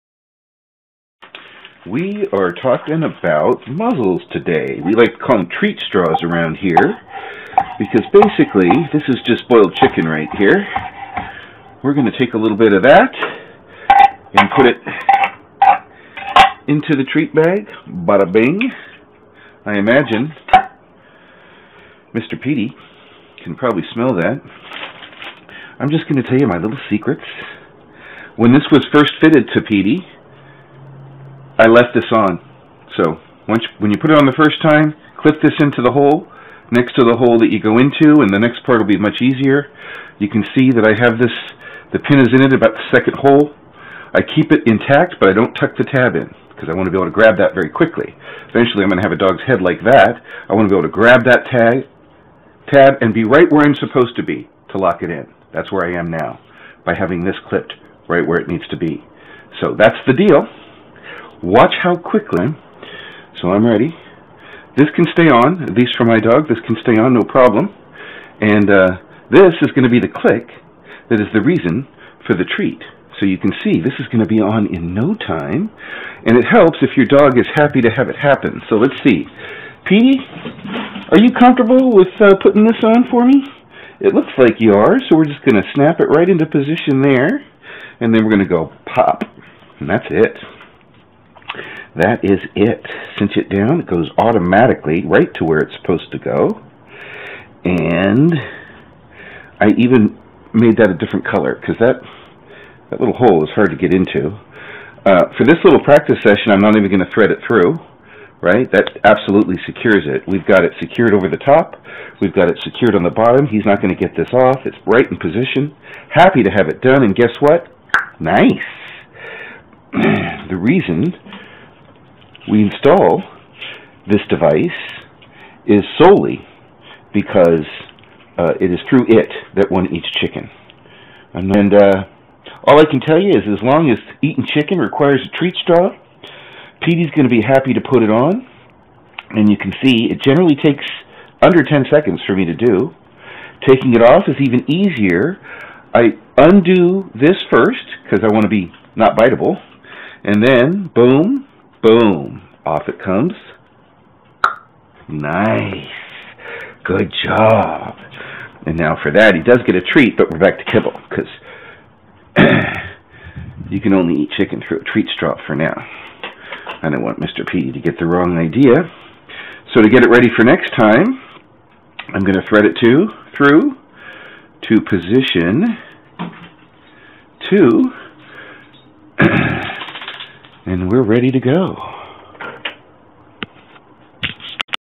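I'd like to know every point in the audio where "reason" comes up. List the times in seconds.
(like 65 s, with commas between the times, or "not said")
71 s, 120 s.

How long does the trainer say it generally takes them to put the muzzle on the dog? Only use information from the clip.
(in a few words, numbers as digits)
under 10 seconds.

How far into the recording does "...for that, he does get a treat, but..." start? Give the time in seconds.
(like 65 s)
159 s.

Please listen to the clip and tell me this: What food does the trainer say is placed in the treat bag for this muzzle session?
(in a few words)
boiled chicken.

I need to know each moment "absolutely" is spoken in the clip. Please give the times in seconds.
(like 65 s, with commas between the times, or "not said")
109 s.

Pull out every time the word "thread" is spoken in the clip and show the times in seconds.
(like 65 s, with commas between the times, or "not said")
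107 s, 172 s.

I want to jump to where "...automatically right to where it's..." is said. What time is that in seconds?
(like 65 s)
94 s.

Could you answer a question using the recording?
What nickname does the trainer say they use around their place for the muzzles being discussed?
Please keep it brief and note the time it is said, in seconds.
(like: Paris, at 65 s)
treat straws, at 5 s.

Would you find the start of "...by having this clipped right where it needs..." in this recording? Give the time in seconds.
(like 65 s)
56 s.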